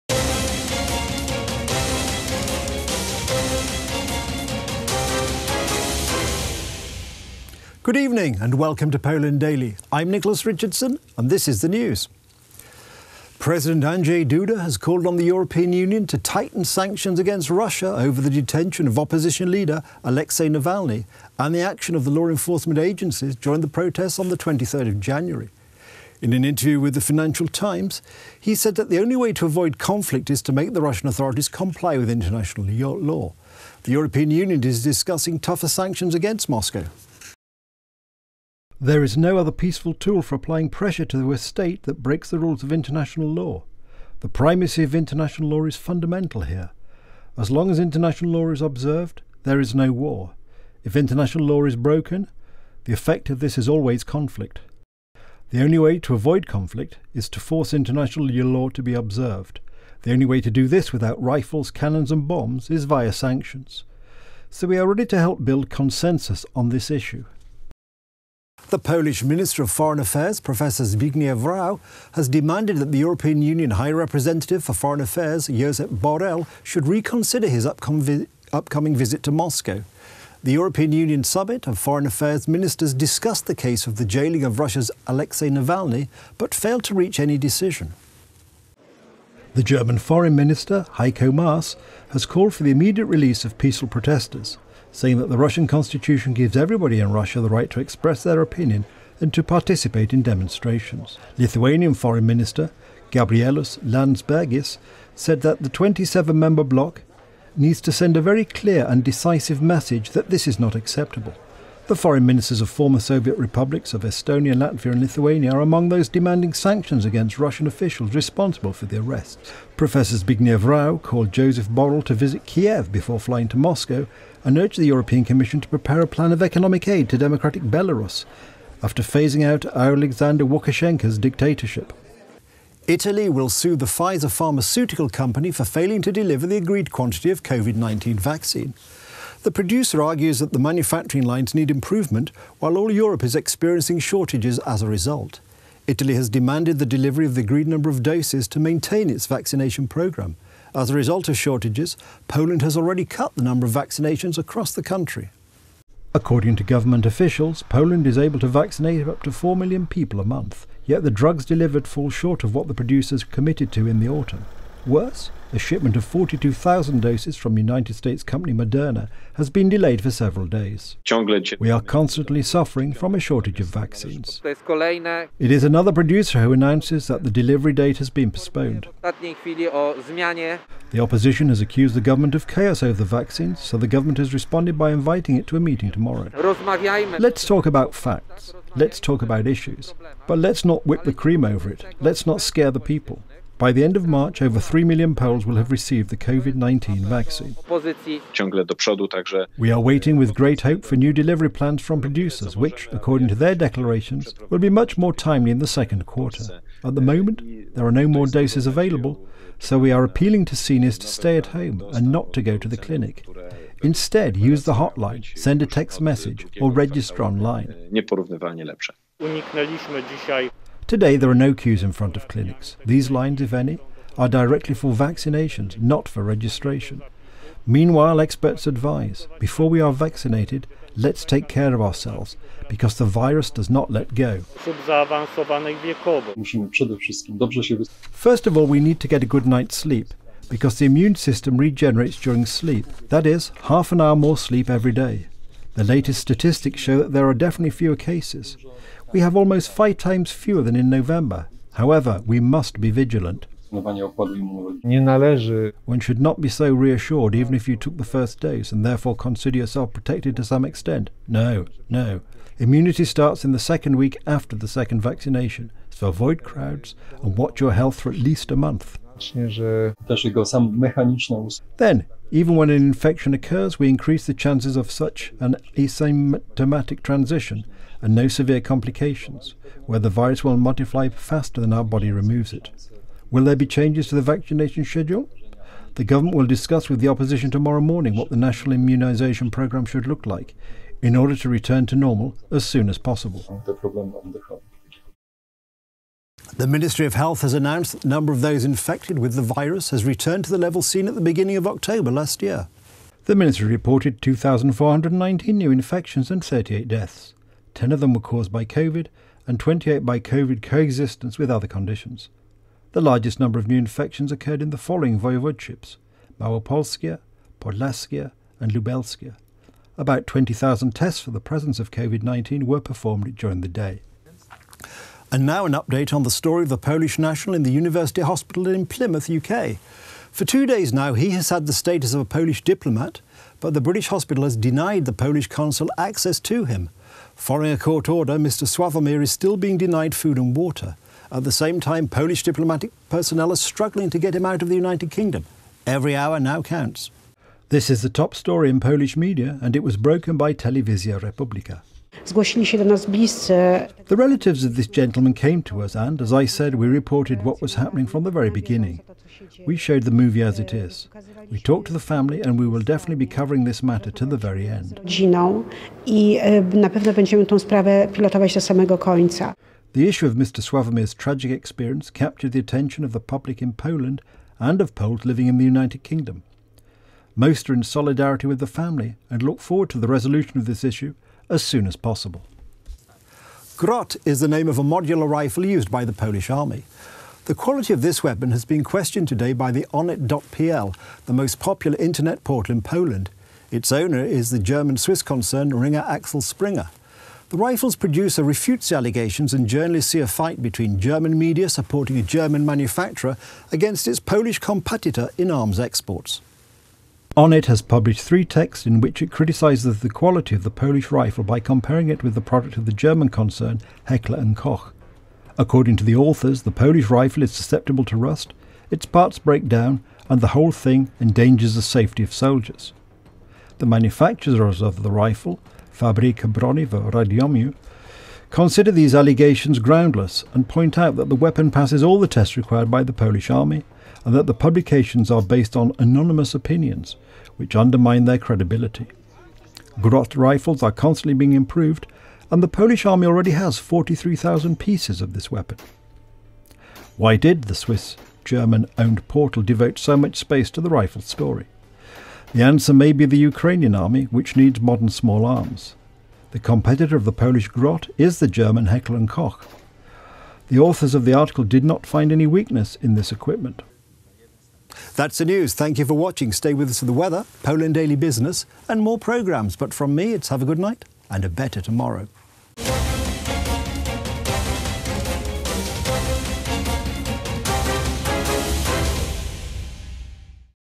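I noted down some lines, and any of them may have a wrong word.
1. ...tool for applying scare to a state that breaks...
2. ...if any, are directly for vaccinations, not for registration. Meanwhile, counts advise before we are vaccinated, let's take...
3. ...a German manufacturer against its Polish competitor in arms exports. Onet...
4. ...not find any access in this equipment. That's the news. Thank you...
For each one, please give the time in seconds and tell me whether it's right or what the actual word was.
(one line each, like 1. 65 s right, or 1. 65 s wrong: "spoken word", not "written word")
1. 39 s wrong: "pressure", not "scare"
2. 223 s wrong: "experts", not "counts"
3. 402 s right
4. 461 s wrong: "weakness", not "access".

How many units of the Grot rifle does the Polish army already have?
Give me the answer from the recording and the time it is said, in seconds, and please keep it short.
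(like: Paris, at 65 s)
43,000, at 443 s.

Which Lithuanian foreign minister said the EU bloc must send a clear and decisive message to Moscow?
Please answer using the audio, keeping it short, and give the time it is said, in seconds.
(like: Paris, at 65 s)
Gabrielus Landsbergis, at 103 s.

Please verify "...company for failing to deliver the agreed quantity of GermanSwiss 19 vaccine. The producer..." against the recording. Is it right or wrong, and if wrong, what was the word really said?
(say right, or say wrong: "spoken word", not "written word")
wrong: "COVID", not "GermanSwiss".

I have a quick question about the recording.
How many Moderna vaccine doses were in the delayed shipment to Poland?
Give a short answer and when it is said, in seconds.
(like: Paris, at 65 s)
42,000, at 166 s.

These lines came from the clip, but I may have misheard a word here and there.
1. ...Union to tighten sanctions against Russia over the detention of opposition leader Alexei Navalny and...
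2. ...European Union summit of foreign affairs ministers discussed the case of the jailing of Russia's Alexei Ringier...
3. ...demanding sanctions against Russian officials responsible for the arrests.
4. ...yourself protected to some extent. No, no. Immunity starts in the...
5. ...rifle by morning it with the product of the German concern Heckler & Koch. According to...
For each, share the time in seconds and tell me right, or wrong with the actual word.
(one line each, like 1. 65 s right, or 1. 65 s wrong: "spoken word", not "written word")
1. 15 s right
2. 80 s wrong: "Navalny", not "Ringier"
3. 116 s right
4. 259 s right
5. 411 s wrong: "comparing", not "morning".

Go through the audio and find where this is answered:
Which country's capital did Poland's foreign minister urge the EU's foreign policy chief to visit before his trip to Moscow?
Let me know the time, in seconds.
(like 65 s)
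122 s.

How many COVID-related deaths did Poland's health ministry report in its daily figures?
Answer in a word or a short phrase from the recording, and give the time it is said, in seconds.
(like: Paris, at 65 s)
38, at 306 s.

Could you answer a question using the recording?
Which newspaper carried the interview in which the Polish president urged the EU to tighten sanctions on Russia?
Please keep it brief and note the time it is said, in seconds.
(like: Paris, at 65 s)
Financial Times, at 27 s.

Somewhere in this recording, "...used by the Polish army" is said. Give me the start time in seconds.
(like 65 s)
385 s.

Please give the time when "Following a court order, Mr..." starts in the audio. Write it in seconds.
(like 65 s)
337 s.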